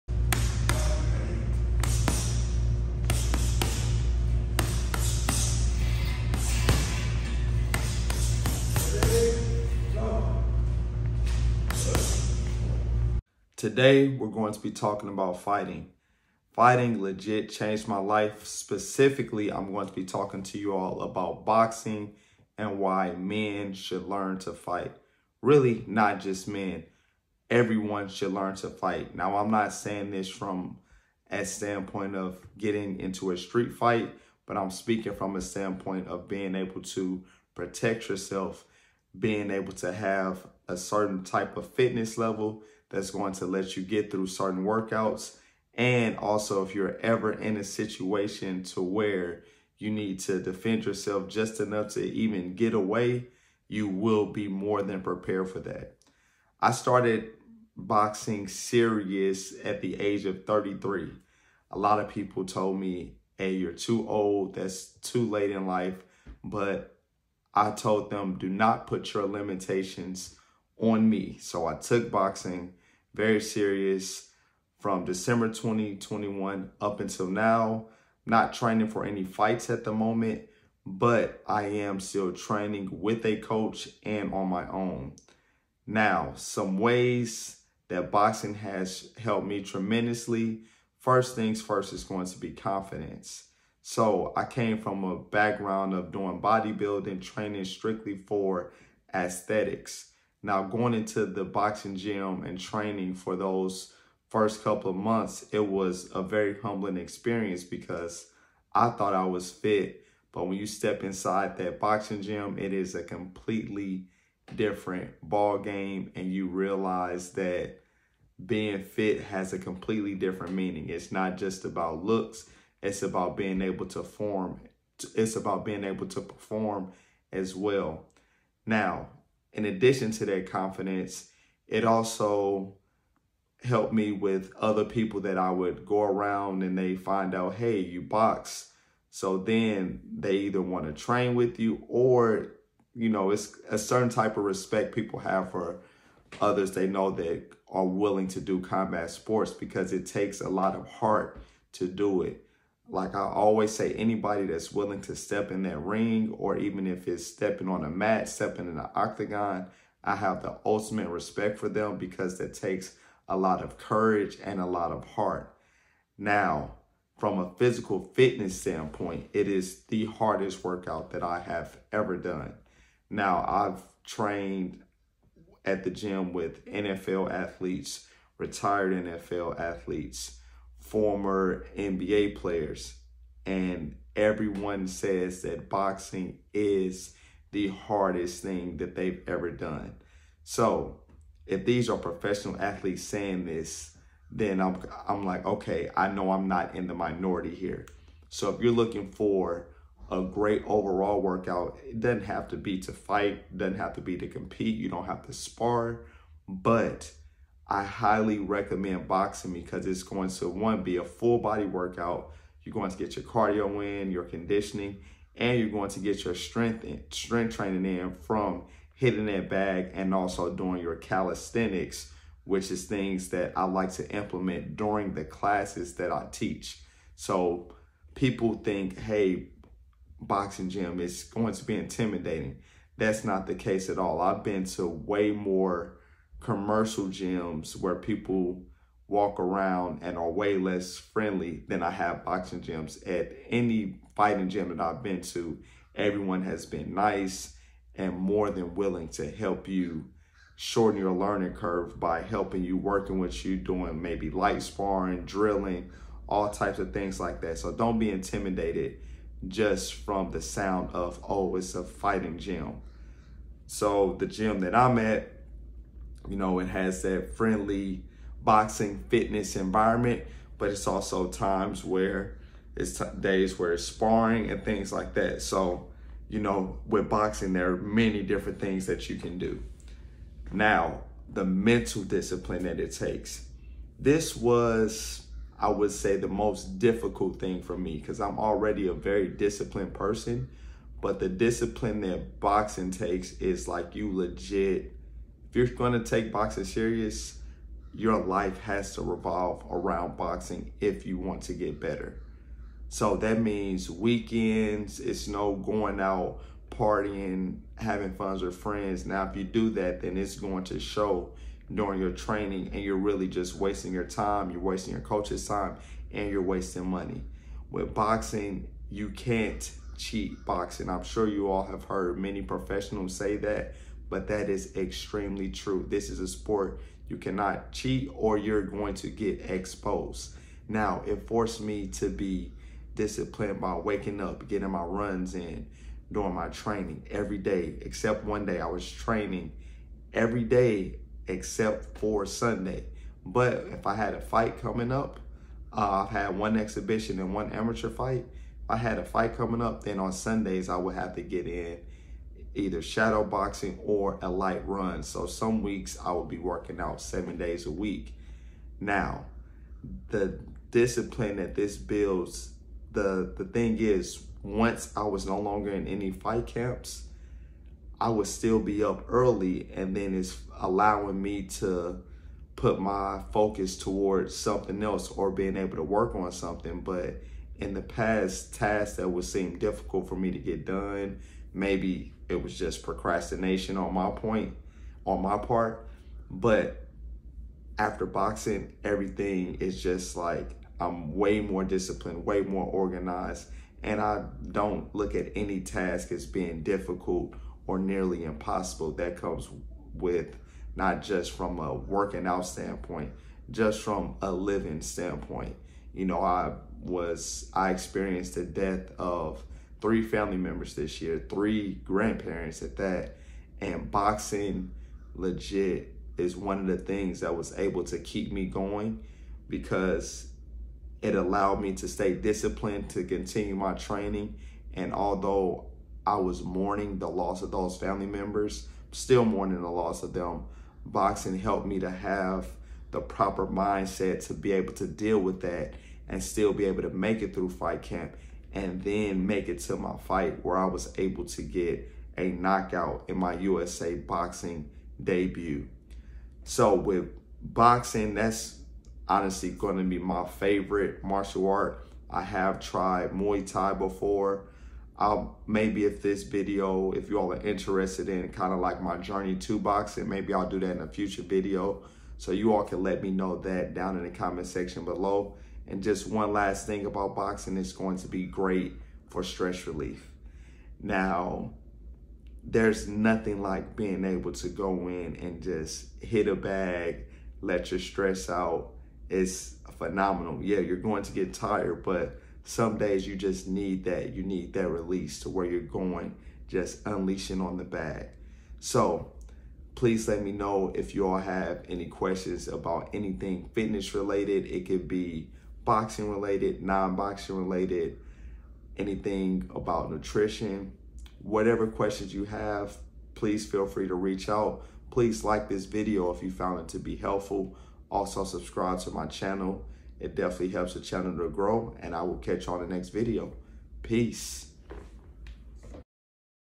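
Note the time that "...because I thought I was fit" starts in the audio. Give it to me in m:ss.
1:47.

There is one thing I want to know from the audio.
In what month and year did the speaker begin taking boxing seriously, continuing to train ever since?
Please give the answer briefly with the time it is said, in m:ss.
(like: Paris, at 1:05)
December 2021, at 1:15.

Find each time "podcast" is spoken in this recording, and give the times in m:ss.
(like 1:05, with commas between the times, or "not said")
not said.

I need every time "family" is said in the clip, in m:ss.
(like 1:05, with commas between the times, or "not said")
6:50, 7:07.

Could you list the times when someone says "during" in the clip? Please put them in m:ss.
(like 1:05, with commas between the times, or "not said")
3:44, 5:11.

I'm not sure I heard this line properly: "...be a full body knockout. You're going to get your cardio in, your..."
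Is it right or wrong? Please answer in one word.
wrong.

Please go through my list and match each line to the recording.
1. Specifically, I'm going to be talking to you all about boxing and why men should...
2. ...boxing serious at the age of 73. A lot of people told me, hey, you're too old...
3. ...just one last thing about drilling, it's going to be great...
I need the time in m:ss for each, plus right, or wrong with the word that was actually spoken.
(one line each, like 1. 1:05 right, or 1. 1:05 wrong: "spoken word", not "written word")
1. 0:18 right
2. 0:57 wrong: "33", not "73"
3. 7:45 wrong: "boxing", not "drilling".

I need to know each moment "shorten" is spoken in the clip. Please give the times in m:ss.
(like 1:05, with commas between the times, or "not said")
4:10.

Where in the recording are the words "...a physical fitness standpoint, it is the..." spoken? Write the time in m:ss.
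2:47.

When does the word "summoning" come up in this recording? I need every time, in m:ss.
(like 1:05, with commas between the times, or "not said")
not said.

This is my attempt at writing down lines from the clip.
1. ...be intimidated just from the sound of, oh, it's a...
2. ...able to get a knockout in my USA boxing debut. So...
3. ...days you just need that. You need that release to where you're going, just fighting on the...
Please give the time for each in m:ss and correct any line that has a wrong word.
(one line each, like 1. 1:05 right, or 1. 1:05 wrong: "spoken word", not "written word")
1. 4:17 right
2. 7:20 right
3. 8:02 wrong: "unleashing", not "fighting".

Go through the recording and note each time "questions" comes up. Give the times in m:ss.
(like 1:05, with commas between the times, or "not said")
8:11, 8:21.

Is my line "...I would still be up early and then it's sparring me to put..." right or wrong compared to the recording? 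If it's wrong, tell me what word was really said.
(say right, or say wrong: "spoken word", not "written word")
wrong: "allowing", not "sparring".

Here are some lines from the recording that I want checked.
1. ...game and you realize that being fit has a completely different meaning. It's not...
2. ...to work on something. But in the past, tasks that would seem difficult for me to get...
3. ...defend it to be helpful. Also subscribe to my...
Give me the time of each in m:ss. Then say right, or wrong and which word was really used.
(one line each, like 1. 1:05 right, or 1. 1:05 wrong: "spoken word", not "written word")
1. 1:55 right
2. 6:15 right
3. 8:26 wrong: "found", not "defend".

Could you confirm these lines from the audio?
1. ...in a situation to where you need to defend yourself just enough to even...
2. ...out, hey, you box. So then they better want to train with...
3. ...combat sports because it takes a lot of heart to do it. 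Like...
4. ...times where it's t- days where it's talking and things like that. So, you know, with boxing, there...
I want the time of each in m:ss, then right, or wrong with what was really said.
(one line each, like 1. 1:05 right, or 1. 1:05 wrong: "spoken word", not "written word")
1. 0:47 right
2. 2:17 wrong: "either", not "better"
3. 2:28 right
4. 4:31 wrong: "sparring", not "talking".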